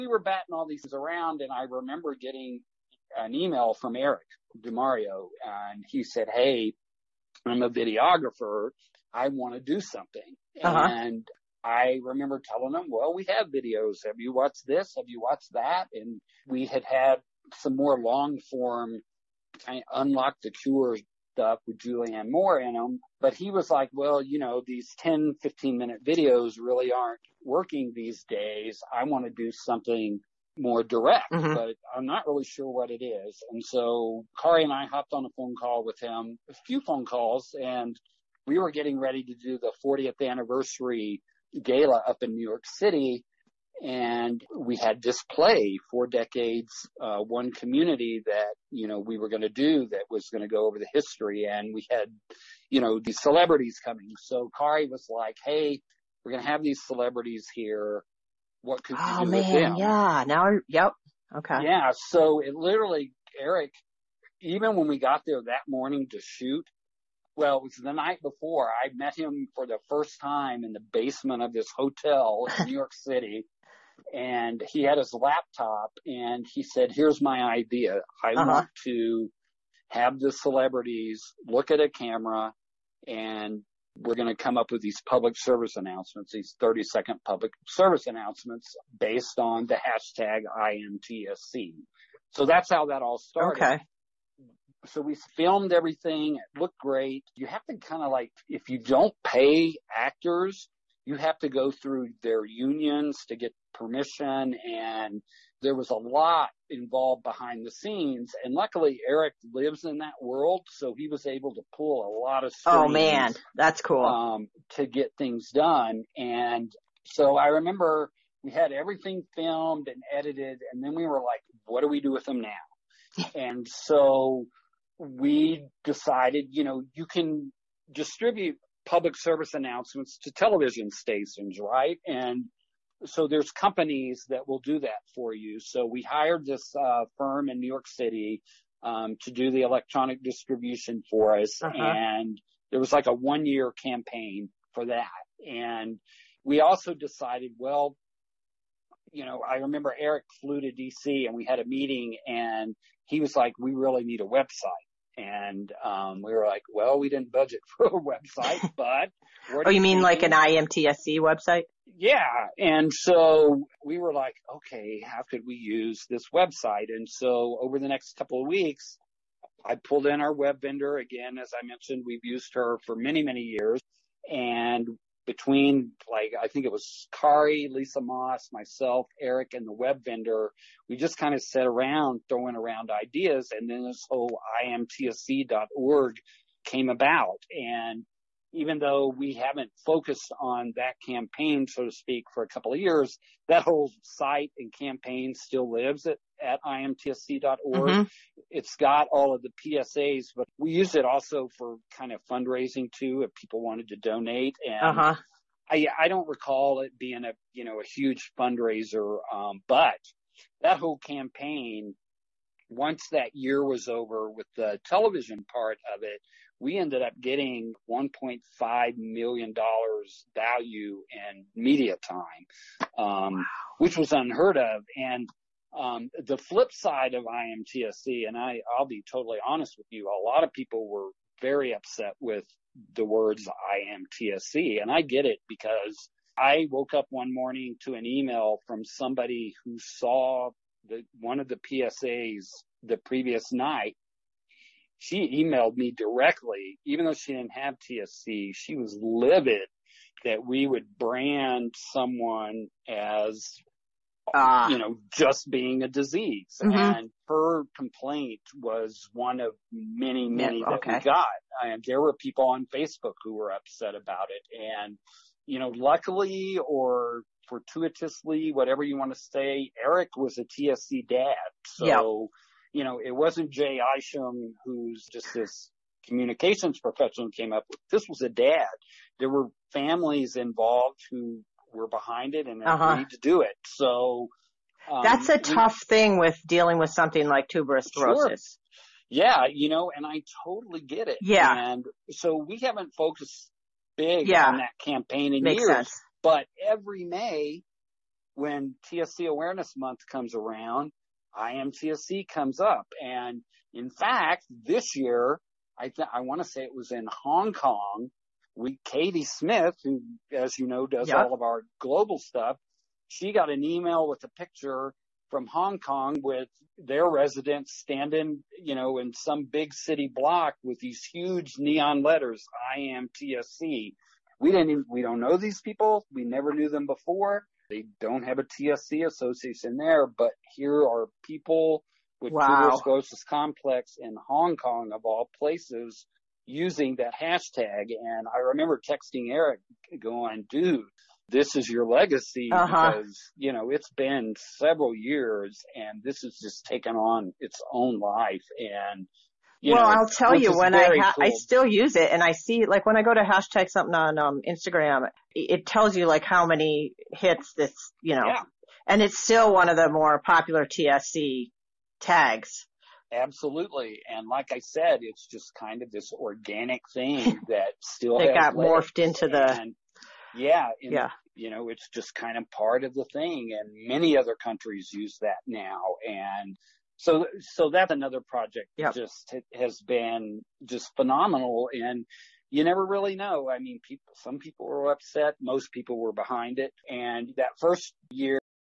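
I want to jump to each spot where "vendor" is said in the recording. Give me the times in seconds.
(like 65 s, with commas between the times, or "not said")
170 s, 180 s.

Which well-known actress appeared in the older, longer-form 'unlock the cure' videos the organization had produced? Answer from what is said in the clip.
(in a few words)
Julianne Moore.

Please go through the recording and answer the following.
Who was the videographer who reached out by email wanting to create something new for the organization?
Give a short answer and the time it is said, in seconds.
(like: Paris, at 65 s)
Eric DeMario, at 3 s.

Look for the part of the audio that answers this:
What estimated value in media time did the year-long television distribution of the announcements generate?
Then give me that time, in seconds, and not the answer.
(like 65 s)
217 s.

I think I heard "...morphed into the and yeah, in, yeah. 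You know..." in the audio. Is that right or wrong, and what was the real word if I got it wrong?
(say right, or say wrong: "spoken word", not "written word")
right.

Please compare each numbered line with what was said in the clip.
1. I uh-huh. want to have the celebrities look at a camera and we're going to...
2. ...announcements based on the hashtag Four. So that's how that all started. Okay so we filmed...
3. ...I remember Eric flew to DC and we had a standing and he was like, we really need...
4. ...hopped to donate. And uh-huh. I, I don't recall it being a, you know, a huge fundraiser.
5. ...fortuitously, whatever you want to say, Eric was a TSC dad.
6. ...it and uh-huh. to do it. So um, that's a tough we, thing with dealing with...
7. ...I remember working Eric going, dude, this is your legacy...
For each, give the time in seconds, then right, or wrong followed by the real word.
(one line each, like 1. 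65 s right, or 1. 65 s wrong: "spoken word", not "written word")
1. 78 s right
2. 88 s wrong: "IMTSC", not "Four"
3. 149 s wrong: "meeting", not "standing"
4. 203 s wrong: "wanted", not "hopped"
5. 267 s right
6. 282 s right
7. 338 s wrong: "texting", not "working".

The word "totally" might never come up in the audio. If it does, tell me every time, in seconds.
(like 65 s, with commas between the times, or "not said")
229 s, 290 s.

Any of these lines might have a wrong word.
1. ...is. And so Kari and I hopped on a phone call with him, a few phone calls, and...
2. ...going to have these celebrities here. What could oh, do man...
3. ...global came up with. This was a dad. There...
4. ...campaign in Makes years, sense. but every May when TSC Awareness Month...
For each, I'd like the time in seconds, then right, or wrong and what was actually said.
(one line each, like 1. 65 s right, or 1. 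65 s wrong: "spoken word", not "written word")
1. 33 s right
2. 56 s right
3. 276 s wrong: "professional", not "global"
4. 294 s right.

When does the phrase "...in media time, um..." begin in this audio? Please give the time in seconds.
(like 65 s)
221 s.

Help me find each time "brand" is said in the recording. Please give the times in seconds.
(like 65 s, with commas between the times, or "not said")
250 s.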